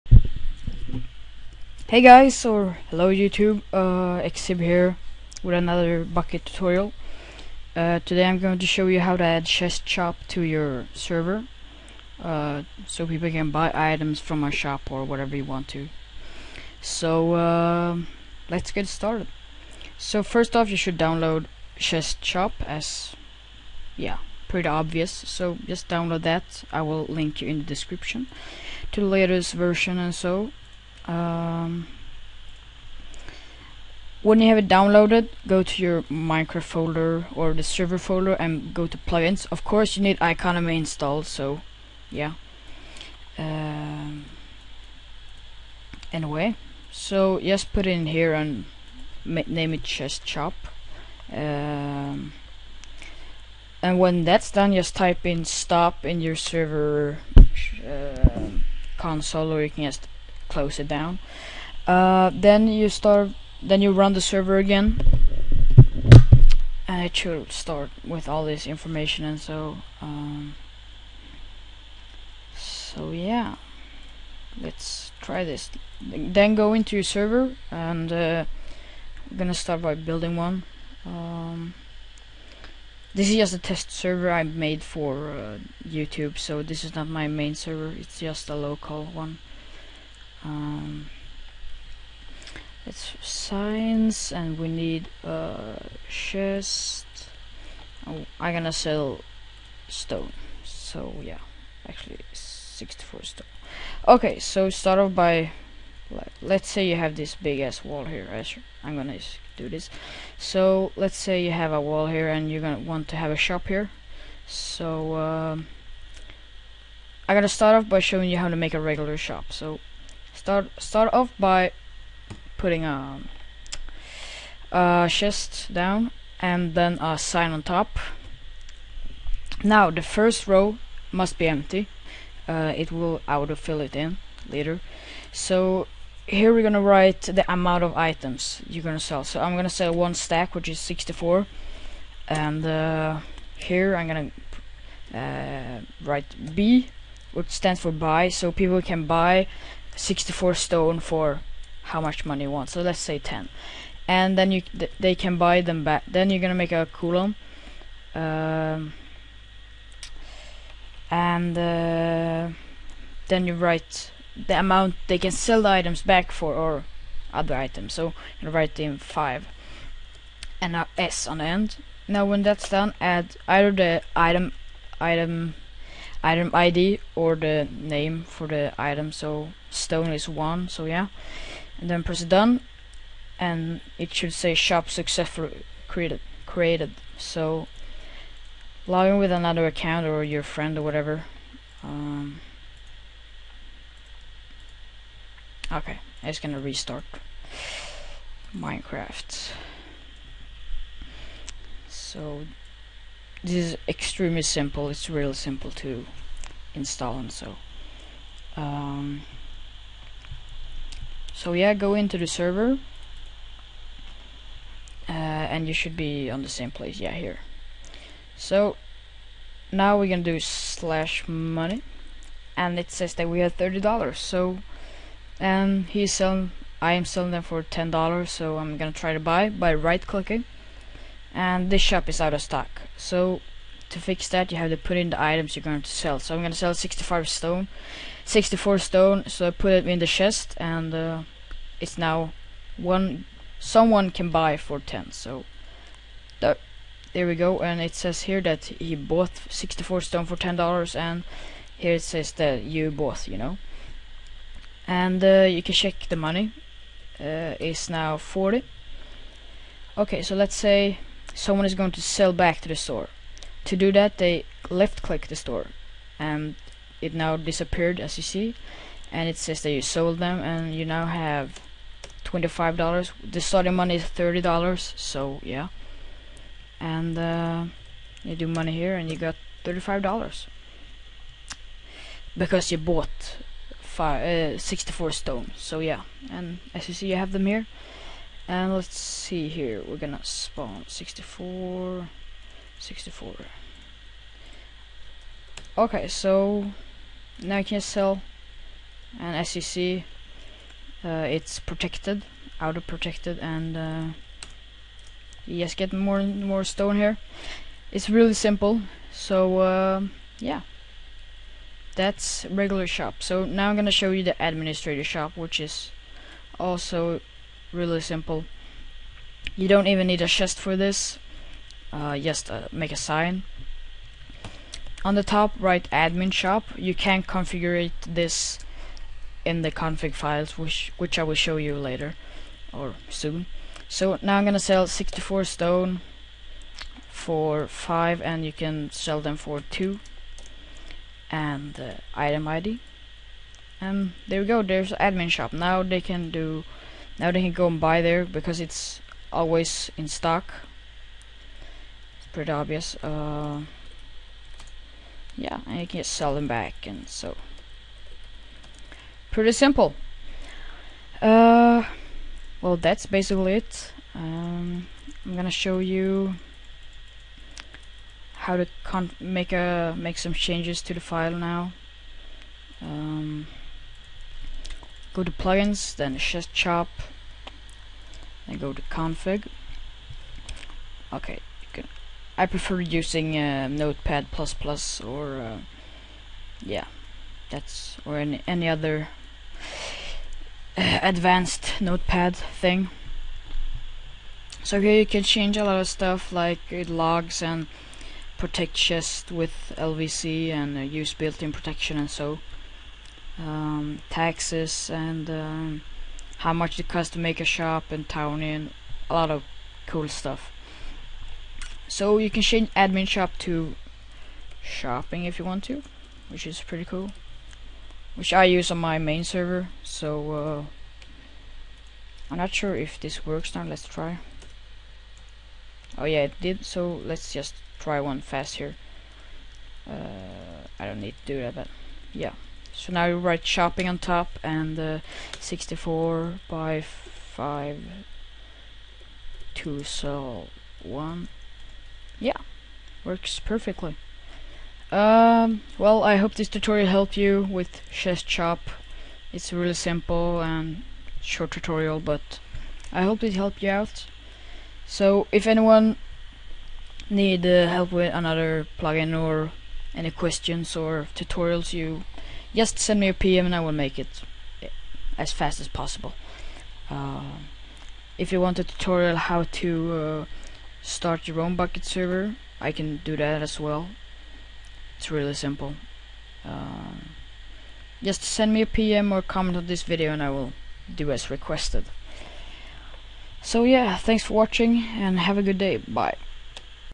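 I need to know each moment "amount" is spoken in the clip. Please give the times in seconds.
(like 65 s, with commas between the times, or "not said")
137 s, 164 s.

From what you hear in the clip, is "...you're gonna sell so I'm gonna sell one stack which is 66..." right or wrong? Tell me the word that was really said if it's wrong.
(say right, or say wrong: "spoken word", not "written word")
wrong: "64", not "66".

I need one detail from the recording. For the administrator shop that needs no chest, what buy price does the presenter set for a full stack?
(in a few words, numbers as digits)
5.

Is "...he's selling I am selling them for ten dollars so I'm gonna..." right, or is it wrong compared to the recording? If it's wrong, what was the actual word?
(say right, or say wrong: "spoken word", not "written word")
right.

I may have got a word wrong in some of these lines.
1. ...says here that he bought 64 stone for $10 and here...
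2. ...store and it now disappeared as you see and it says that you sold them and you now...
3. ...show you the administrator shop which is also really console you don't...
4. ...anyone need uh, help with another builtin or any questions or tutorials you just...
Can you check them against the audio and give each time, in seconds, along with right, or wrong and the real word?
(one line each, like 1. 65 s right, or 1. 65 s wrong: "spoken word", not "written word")
1. 247 s right
2. 265 s right
3. 313 s wrong: "simple", not "console"
4. 455 s wrong: "plugin", not "builtin".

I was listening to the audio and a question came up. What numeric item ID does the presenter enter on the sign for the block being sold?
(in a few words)
1.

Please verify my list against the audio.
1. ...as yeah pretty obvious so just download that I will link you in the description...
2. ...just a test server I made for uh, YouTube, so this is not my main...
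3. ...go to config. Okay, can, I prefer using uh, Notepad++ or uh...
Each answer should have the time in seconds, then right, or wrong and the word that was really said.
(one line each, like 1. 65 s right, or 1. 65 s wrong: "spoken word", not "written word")
1. 22 s right
2. 83 s right
3. 378 s right.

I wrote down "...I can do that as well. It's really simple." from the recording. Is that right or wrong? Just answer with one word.
right.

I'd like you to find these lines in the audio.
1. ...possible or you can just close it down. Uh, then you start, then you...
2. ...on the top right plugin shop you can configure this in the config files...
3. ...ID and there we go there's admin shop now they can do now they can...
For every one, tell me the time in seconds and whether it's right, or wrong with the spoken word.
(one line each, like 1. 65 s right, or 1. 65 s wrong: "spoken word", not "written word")
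1. 58 s wrong: "console", not "possible"
2. 325 s wrong: "admin", not "plugin"
3. 342 s right.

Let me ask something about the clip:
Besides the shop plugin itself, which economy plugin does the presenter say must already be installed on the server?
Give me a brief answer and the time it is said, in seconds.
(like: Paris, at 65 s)
iConomy, at 40 s.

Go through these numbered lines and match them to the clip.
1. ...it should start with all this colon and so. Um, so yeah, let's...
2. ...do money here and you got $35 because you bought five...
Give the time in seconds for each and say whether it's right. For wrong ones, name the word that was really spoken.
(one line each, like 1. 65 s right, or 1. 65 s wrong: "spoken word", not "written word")
1. 67 s wrong: "information", not "colon"
2. 278 s right.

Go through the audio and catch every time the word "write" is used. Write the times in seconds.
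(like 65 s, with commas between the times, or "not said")
136 s, 146 s, 163 s, 168 s, 433 s.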